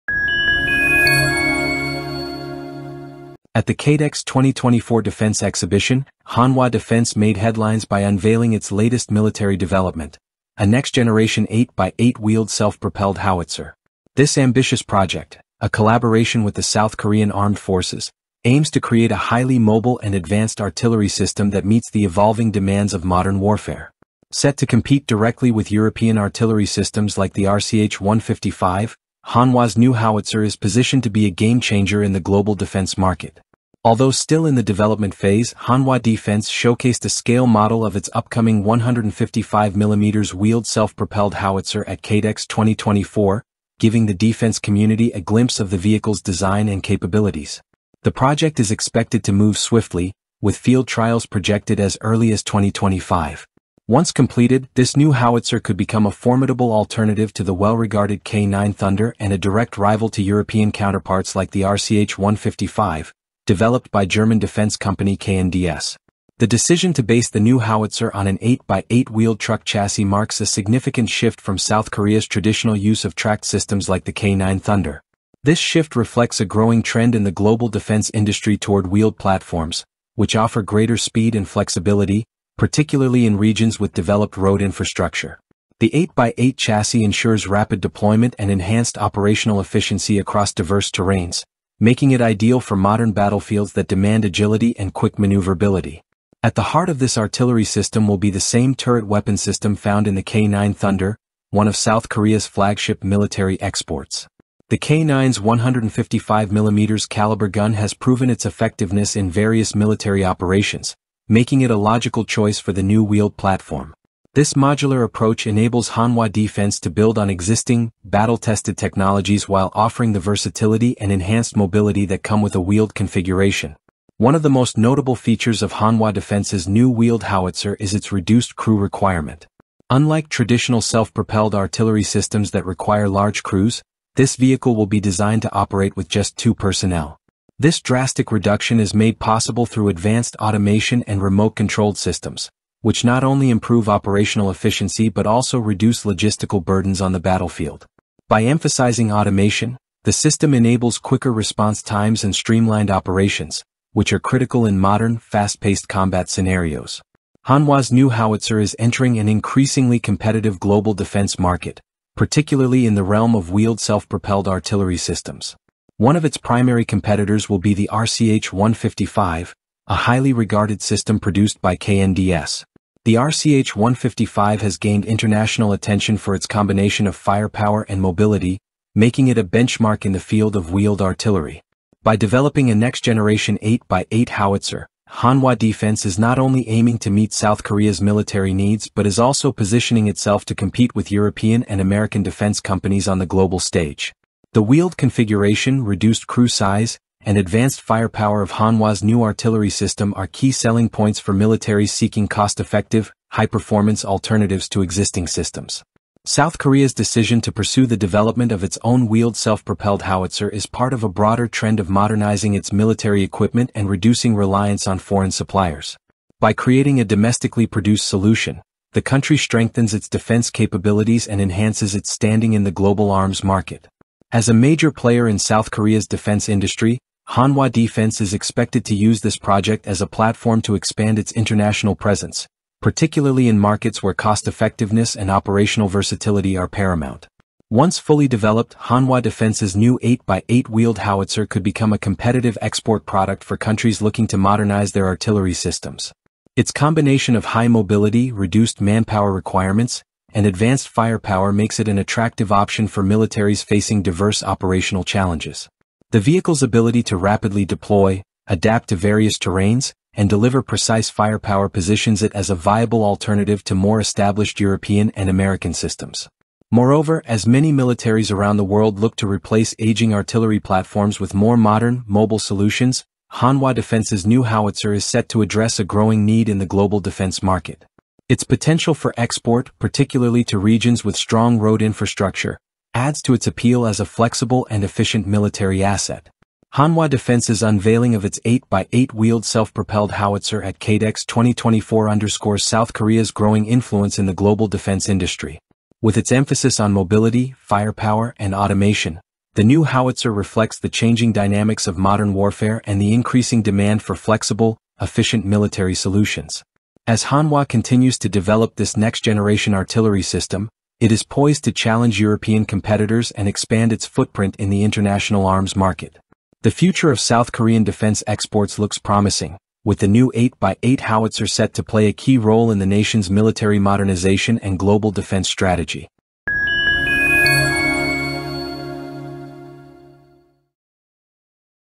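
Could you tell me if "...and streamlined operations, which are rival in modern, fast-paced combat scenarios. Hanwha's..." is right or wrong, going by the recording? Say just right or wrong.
wrong.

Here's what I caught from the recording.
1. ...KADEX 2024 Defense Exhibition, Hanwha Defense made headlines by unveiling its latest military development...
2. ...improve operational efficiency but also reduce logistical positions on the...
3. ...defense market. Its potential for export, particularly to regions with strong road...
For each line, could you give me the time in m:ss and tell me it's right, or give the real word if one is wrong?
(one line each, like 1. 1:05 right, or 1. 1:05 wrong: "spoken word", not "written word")
1. 0:03 right
2. 2:23 wrong: "burdens", not "positions"
3. 4:36 right.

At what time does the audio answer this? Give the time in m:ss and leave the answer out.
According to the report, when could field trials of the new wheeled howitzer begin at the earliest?
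0:52.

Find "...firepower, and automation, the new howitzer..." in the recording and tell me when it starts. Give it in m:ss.
4:57.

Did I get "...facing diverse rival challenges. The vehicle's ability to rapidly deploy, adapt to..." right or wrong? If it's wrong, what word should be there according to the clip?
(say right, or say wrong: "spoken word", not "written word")
wrong: "operational", not "rival".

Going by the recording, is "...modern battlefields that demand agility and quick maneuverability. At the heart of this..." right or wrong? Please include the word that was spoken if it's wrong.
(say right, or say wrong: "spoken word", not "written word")
right.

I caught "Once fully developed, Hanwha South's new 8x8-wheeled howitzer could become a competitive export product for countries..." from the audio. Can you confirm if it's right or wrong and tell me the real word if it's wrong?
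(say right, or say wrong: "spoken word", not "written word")
wrong: "Defense", not "South".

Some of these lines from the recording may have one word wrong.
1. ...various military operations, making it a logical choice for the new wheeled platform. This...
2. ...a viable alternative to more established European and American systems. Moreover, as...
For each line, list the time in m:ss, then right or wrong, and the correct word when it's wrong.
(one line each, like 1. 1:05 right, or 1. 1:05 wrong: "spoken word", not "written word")
1. 1:49 right
2. 4:22 right.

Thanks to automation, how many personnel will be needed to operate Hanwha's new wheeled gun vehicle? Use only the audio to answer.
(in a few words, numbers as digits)
2.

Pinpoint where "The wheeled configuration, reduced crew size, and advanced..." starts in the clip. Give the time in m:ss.
3:14.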